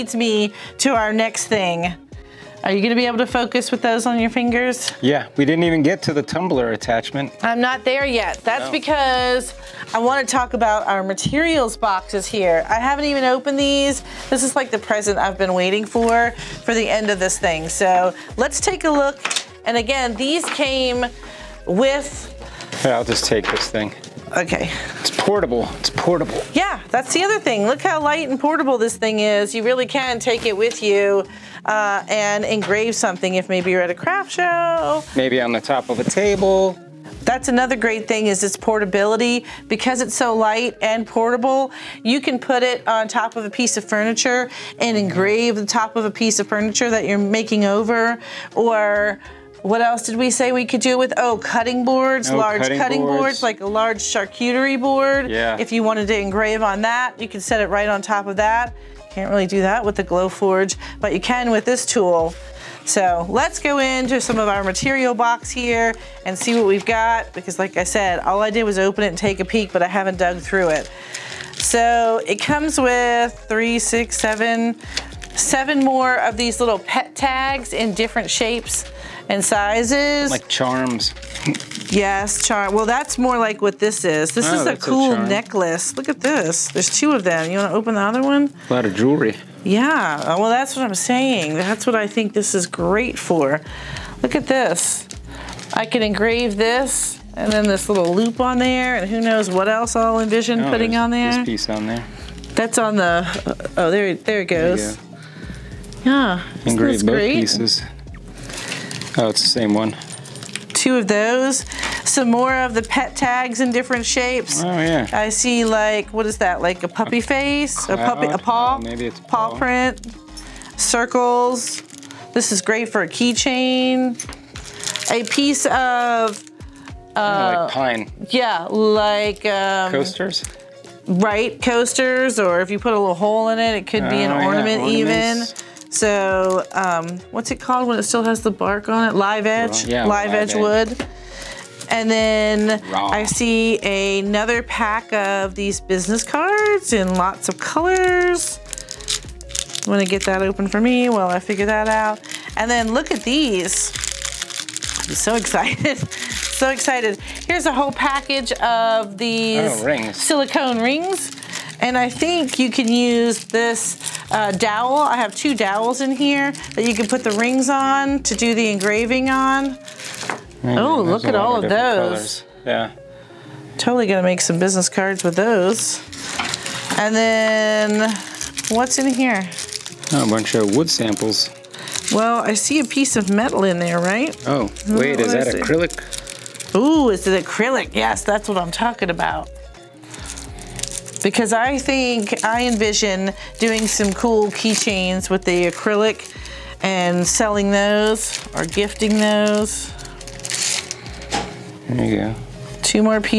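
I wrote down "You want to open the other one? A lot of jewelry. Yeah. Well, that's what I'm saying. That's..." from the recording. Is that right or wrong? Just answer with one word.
right.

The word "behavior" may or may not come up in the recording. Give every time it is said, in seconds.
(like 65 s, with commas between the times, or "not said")
not said.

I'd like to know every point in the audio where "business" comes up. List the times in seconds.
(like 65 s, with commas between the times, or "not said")
145 s, 174 s.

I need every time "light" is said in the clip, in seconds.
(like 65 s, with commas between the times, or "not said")
28 s, 40 s.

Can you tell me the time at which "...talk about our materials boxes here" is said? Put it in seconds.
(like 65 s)
10 s.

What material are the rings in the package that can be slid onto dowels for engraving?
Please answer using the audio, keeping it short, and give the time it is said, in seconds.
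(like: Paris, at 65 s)
Silicone, at 160 s.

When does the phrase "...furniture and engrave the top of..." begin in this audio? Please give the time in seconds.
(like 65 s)
43 s.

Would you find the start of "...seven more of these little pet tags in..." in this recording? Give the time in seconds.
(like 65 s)
75 s.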